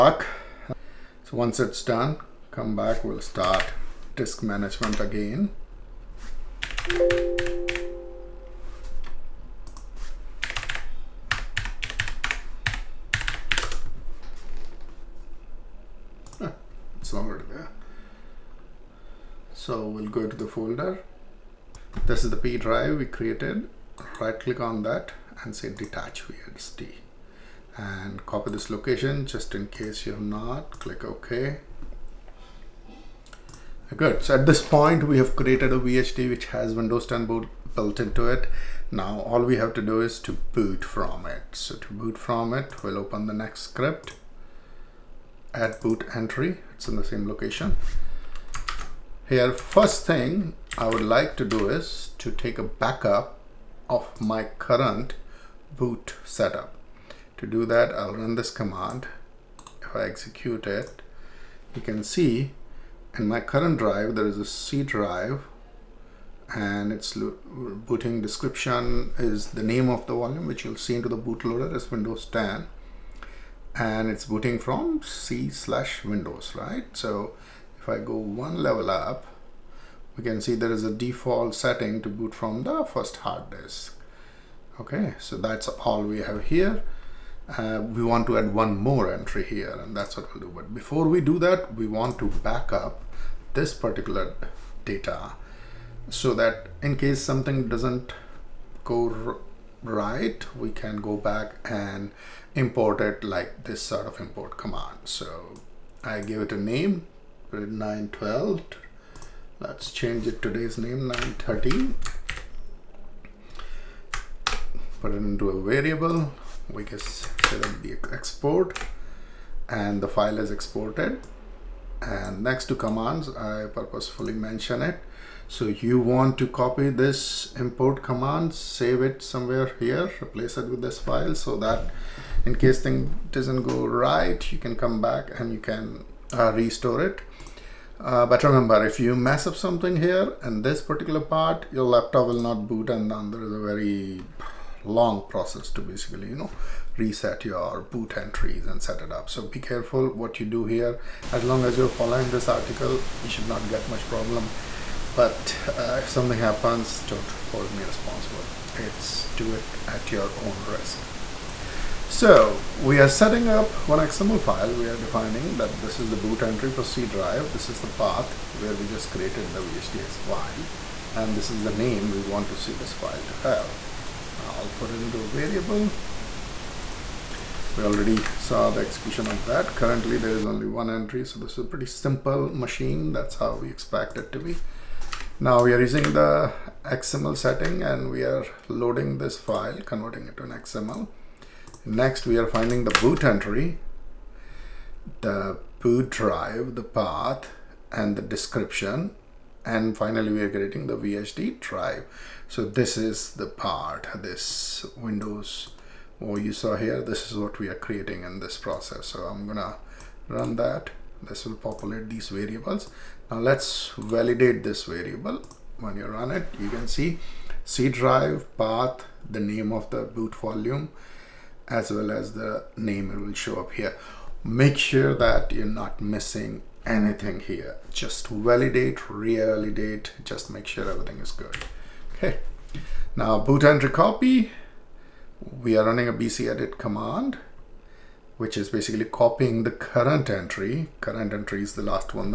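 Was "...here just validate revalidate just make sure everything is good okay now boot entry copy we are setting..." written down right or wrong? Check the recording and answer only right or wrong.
wrong.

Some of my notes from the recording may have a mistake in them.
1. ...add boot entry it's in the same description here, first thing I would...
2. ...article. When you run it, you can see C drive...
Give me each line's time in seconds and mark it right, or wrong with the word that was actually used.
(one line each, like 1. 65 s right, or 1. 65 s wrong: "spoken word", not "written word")
1. 45 s wrong: "location", not "description"
2. 214 s wrong: "variable", not "article".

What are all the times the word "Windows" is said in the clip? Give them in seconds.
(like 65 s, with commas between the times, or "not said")
36 s, 71 s, 76 s, 204 s.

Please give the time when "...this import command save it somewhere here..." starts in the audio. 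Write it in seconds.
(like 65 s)
126 s.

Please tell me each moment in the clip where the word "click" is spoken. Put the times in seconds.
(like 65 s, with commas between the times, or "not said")
24 s, 30 s.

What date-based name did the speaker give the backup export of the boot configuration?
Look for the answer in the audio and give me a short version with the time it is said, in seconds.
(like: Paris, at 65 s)
913, at 111 s.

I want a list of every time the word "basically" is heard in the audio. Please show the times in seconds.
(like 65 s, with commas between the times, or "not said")
145 s, 238 s.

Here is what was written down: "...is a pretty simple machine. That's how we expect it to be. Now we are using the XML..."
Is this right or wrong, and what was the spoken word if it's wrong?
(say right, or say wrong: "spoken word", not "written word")
right.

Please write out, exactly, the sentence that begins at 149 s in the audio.
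So be careful what you do here.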